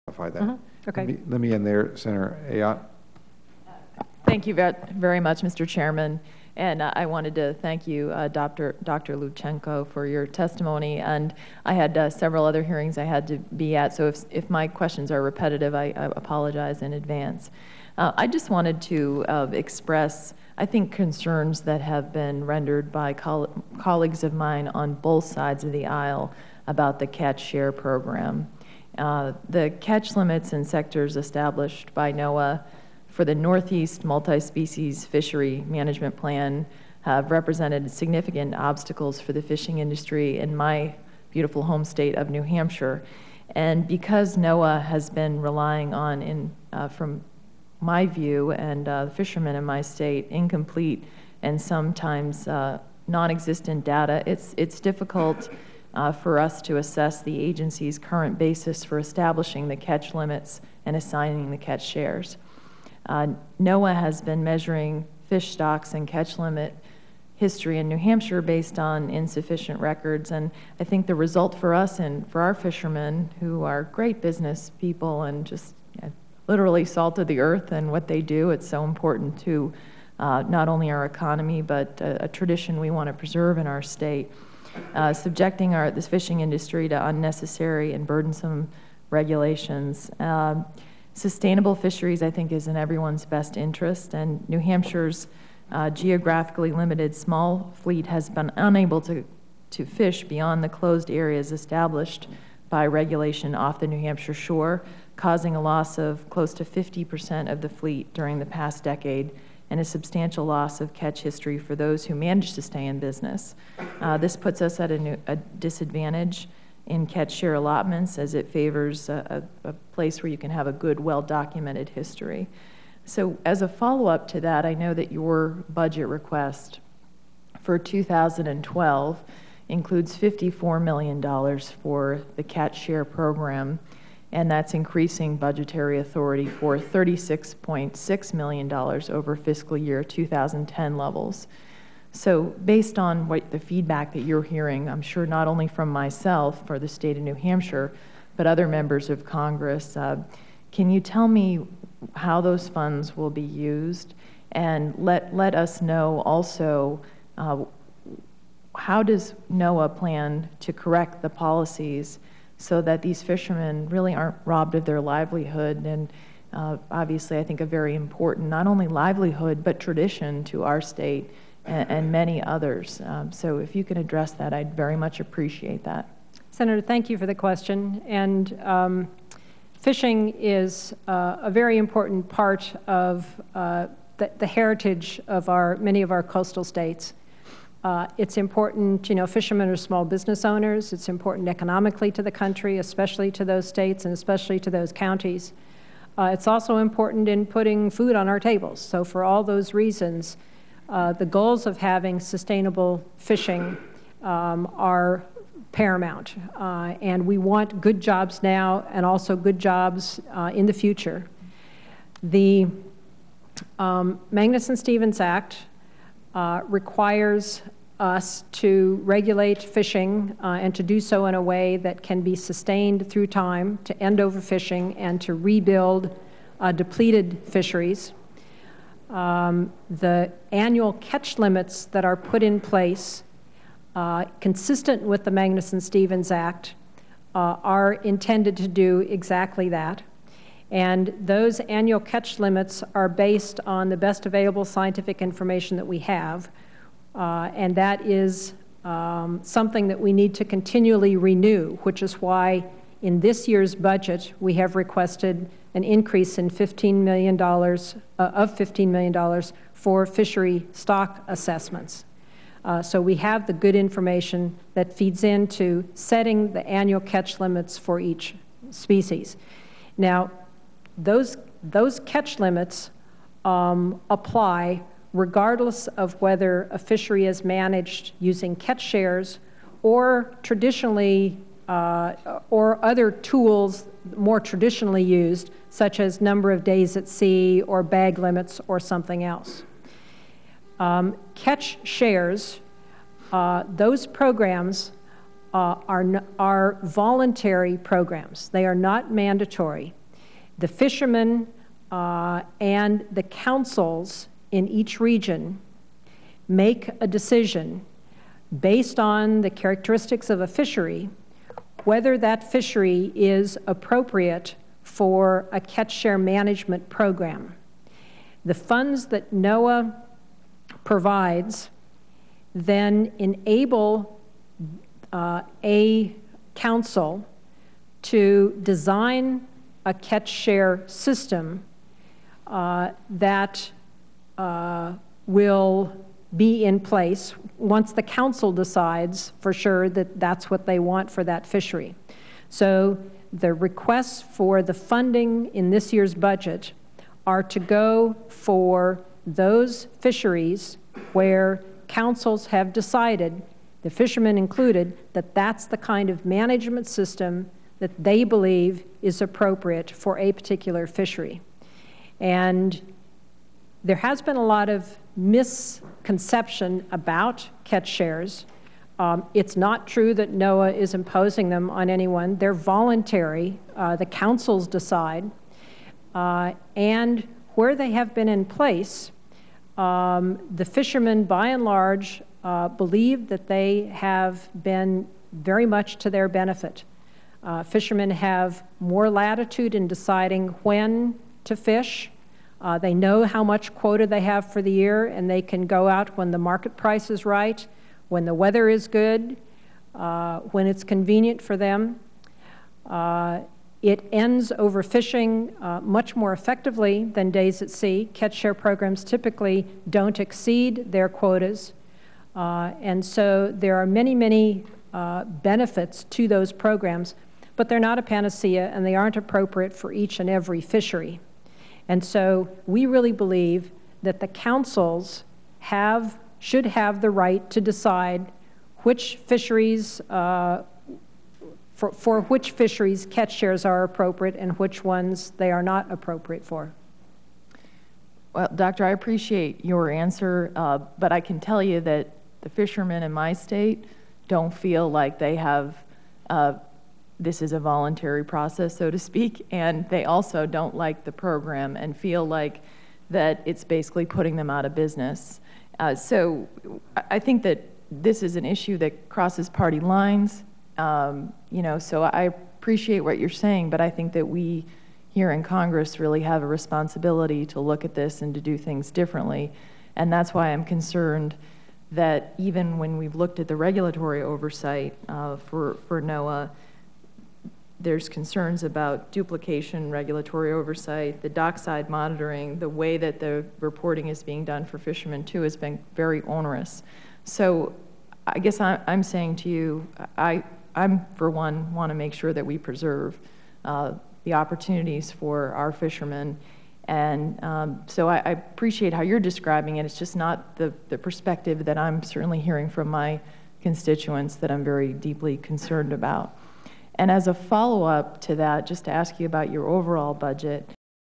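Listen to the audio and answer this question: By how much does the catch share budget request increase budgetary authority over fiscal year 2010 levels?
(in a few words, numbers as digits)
$36.6 million.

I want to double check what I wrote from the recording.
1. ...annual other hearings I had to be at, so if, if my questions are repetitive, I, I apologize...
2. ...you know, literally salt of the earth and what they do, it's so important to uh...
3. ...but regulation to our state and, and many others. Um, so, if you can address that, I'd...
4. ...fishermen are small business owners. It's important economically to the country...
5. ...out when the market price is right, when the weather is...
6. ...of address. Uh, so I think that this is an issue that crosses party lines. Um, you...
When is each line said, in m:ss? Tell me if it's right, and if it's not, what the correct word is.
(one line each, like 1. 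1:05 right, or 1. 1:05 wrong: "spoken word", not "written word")
1. 0:12 wrong: "several", not "annual"
2. 1:15 right
3. 2:49 wrong: "tradition", not "regulation"
4. 3:09 right
5. 6:35 right
6. 7:34 wrong: "business", not "address".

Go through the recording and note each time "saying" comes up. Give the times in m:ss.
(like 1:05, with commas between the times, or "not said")
7:43, 8:09.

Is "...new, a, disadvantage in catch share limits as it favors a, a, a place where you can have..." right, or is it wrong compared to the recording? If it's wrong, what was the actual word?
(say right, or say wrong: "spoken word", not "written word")
wrong: "allotments", not "limits".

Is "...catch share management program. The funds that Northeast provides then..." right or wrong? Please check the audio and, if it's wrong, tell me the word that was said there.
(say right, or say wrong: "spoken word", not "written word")
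wrong: "NOAA", not "Northeast".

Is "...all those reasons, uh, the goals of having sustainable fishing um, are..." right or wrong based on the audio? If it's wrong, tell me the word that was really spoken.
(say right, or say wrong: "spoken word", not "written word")
right.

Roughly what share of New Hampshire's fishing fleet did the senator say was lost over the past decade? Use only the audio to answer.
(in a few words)
50 percent.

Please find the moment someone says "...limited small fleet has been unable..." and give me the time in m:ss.
1:36.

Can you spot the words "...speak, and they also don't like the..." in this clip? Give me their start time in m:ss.
7:28.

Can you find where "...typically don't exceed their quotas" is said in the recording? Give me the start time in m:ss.
6:49.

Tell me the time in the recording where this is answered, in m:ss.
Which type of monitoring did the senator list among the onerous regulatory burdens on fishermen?
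8:01.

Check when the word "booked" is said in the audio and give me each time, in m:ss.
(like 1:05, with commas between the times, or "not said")
not said.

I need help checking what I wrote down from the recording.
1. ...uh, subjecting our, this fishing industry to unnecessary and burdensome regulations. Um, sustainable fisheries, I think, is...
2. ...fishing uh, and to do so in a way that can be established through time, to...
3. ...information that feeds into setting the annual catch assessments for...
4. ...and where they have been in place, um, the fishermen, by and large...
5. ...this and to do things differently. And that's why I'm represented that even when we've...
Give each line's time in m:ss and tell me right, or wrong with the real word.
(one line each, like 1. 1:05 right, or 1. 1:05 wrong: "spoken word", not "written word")
1. 1:24 right
2. 3:39 wrong: "sustained", not "established"
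3. 4:23 wrong: "limits", not "assessments"
4. 6:16 right
5. 7:47 wrong: "concerned", not "represented".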